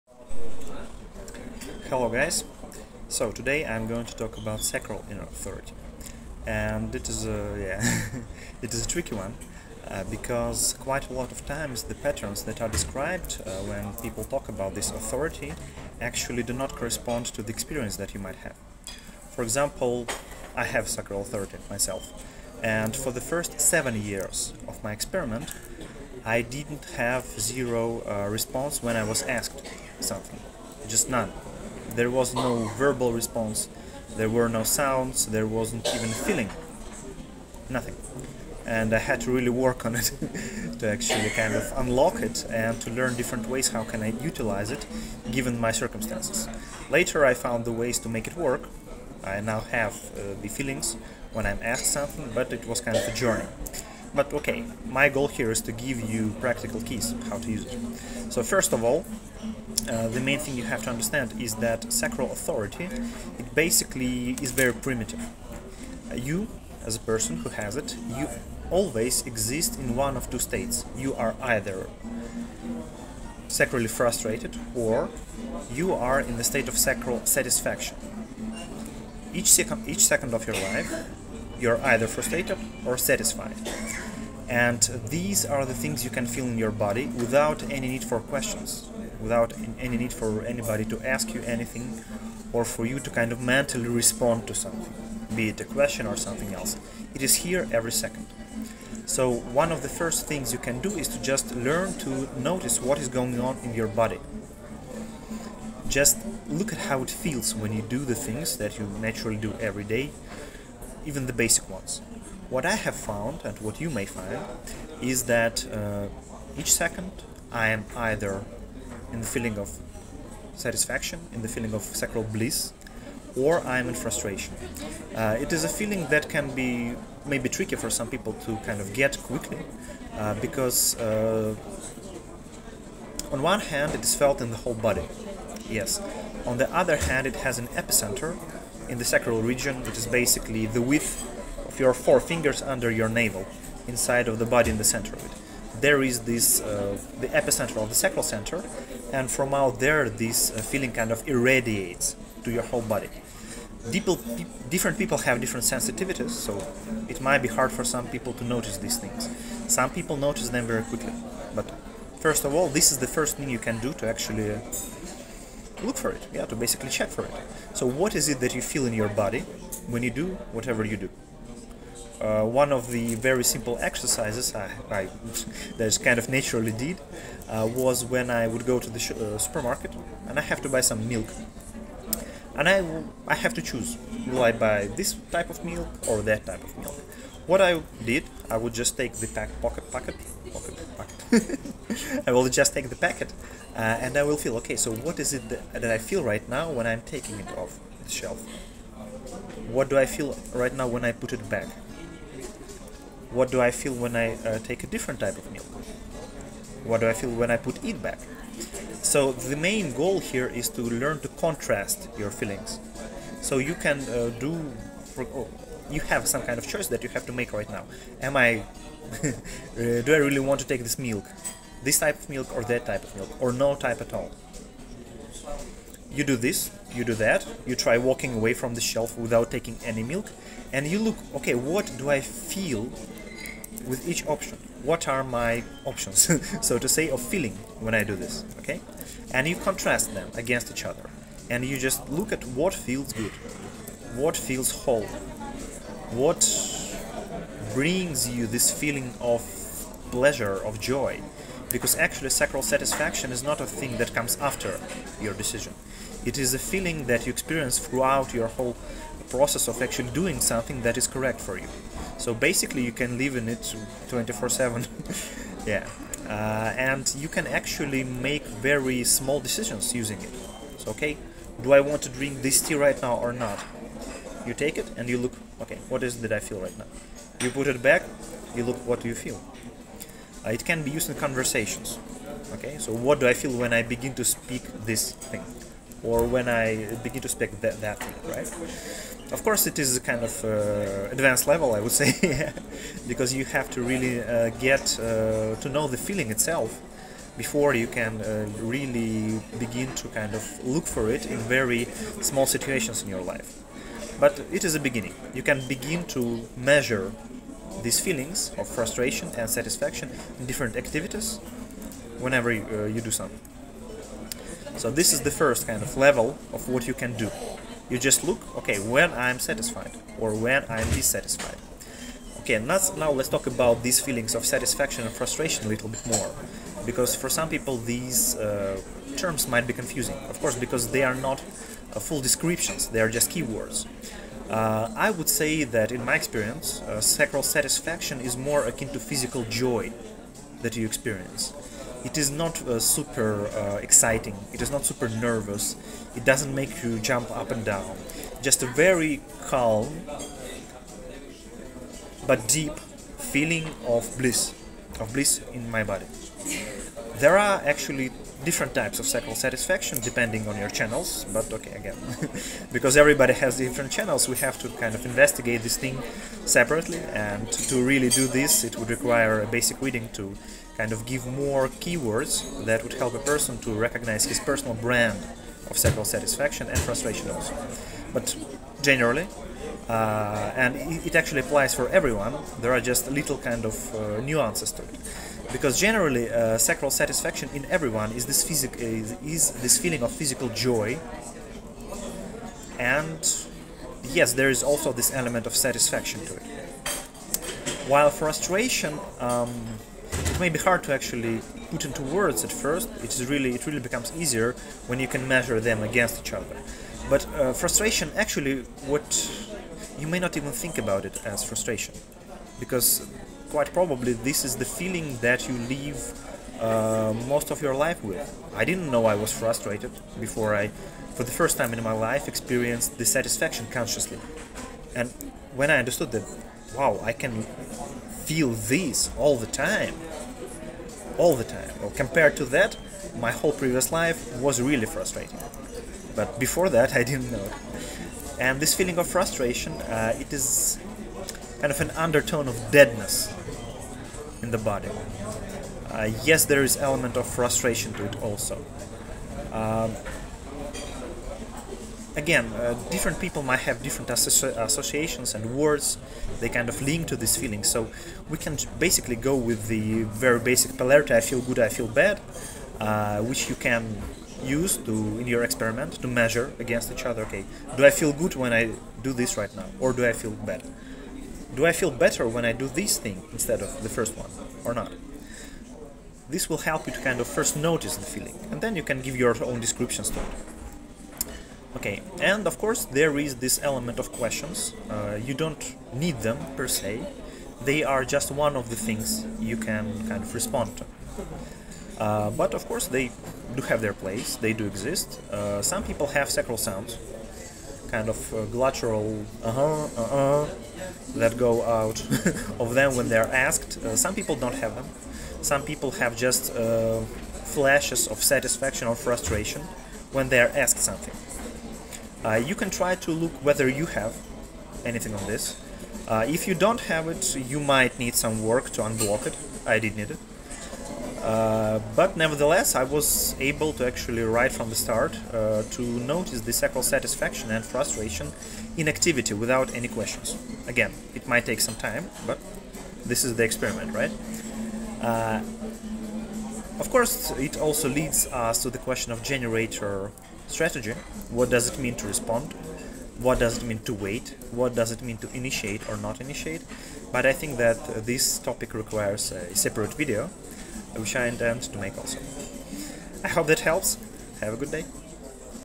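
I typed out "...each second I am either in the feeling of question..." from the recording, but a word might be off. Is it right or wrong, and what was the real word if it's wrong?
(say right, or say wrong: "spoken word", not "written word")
wrong: "satisfaction", not "question".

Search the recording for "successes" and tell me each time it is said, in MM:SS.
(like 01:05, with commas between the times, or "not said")
not said.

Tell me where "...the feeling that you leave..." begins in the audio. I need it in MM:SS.
06:54.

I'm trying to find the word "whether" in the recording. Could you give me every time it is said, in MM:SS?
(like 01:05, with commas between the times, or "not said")
08:33.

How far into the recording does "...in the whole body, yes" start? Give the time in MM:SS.
02:14.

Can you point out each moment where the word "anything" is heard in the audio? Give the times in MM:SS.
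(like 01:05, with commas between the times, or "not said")
01:31, 08:34.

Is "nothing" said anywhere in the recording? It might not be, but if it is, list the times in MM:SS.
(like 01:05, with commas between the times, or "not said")
00:37.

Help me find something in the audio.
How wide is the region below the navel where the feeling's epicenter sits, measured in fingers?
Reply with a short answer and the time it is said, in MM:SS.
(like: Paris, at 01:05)
4 fingers, at 02:22.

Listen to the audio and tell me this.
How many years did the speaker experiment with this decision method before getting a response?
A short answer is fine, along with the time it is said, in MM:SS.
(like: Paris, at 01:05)
7, at 00:23.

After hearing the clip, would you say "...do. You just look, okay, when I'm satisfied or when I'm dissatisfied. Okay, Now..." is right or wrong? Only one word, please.
right.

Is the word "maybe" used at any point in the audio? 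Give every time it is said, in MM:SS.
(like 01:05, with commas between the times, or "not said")
02:07.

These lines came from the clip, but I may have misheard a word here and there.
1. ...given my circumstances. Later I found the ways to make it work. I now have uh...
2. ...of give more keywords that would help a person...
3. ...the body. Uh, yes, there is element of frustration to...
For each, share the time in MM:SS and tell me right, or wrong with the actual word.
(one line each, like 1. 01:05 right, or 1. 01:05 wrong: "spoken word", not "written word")
1. 00:45 right
2. 06:10 right
3. 07:24 right.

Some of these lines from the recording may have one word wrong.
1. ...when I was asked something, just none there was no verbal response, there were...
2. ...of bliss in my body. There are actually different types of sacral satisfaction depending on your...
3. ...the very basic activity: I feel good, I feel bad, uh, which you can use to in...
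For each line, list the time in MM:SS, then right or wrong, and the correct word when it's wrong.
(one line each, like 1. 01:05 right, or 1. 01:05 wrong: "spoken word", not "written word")
1. 00:28 right
2. 05:54 right
3. 07:39 wrong: "polarity", not "activity".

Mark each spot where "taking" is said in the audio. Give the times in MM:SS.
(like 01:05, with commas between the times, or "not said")
03:17, 03:49.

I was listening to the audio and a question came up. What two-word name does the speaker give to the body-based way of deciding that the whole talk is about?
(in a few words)
sacral inner authority.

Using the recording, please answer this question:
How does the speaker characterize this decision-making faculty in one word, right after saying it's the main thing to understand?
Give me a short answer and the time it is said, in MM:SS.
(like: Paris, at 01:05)
primitive, at 01:04.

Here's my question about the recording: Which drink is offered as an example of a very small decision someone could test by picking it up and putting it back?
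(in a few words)
tea.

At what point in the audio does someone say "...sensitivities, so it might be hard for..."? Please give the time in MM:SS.
02:35.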